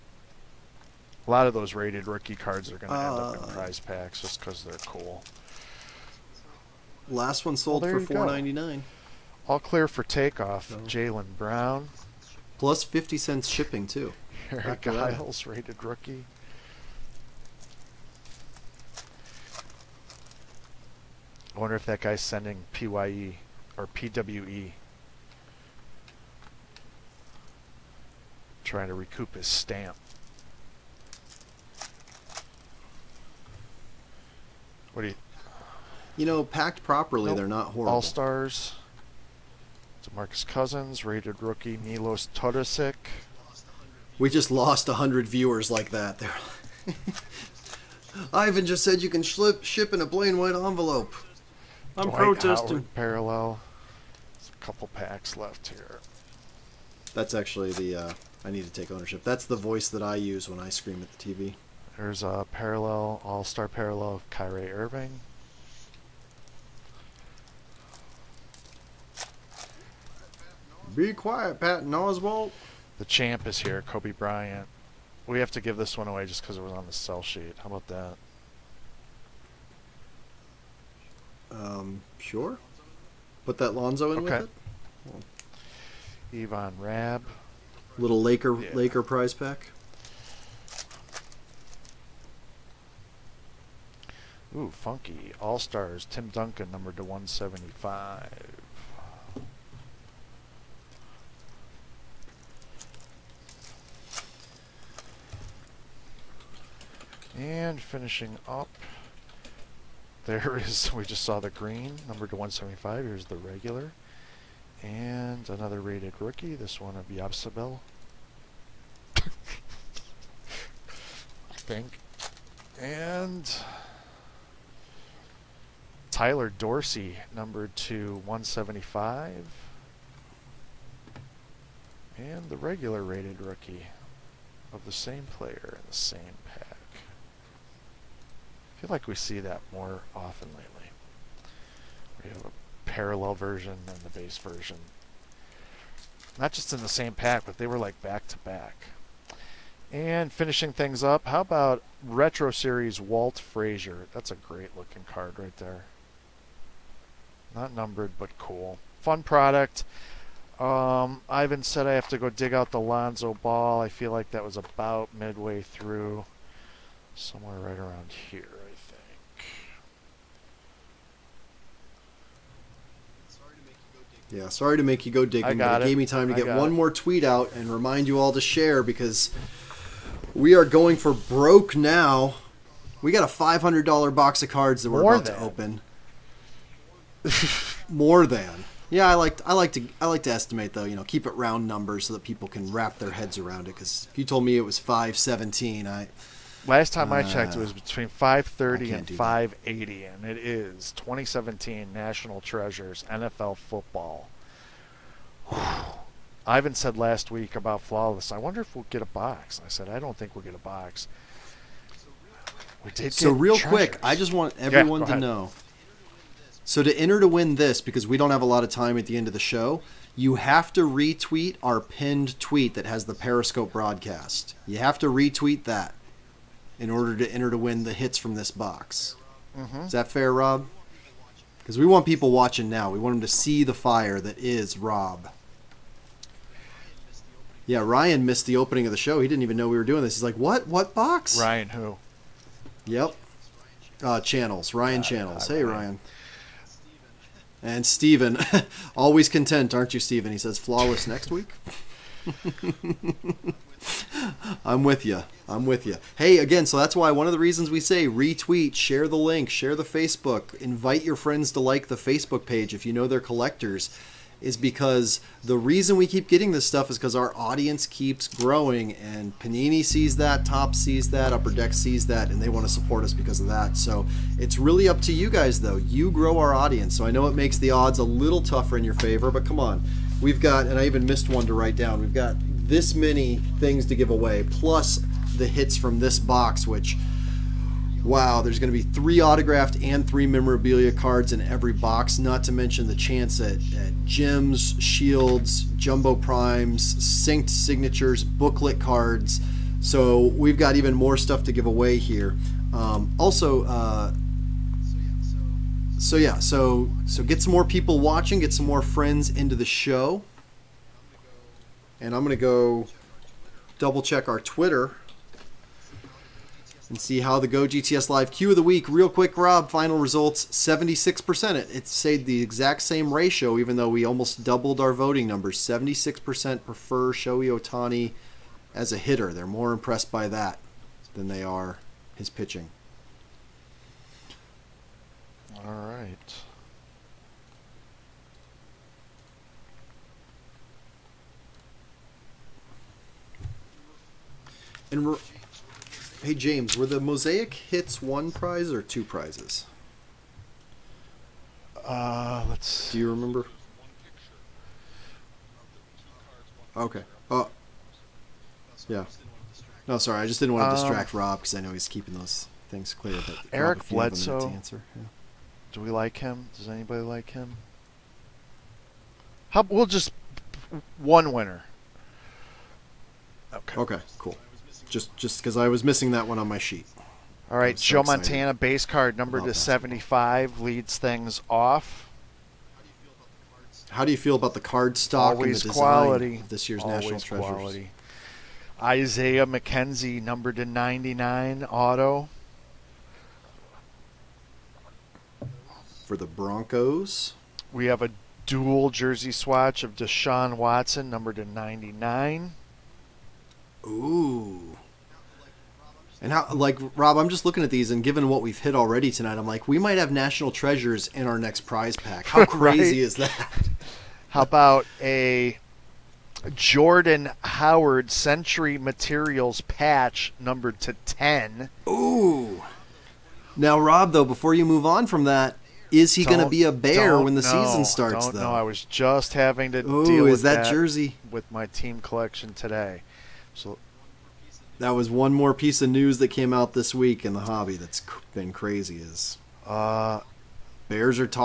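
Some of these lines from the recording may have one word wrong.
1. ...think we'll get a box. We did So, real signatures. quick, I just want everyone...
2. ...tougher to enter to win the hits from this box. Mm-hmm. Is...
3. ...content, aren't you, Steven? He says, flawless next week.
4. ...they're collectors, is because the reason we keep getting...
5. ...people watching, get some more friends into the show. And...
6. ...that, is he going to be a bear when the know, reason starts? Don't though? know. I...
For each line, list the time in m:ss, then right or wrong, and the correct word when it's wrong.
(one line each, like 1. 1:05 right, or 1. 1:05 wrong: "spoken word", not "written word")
1. 3:30 wrong: "treasures", not "signatures"
2. 3:46 wrong: "order", not "tougher"
3. 4:09 right
4. 4:23 right
5. 5:07 right
6. 7:05 wrong: "season", not "reason".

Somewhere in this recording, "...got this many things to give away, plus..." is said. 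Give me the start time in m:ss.
4:42.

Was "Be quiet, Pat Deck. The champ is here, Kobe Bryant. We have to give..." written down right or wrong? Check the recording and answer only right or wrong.
wrong.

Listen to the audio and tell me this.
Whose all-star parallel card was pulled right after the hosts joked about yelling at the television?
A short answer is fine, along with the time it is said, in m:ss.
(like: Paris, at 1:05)
Kyrie Irving, at 1:04.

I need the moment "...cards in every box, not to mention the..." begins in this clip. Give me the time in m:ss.
4:50.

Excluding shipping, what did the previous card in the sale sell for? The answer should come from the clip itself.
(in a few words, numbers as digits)
$4.99.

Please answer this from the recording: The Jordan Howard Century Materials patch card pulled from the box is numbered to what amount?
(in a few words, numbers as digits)
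10.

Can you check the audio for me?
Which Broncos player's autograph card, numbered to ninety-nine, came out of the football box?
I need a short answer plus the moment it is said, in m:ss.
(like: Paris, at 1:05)
Isaiah McKenzie, at 6:29.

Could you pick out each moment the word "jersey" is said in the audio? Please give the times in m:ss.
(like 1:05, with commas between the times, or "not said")
6:38, 7:10.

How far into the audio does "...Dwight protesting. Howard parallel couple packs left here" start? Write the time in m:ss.
0:52.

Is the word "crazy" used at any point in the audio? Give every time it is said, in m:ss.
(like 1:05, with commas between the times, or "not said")
6:52, 7:18.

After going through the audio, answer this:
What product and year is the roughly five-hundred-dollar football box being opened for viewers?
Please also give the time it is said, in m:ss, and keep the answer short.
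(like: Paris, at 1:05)
2017 National Treasures, at 3:20.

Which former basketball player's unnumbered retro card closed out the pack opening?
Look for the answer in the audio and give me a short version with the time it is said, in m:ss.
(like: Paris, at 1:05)
Walt Frazier, at 2:32.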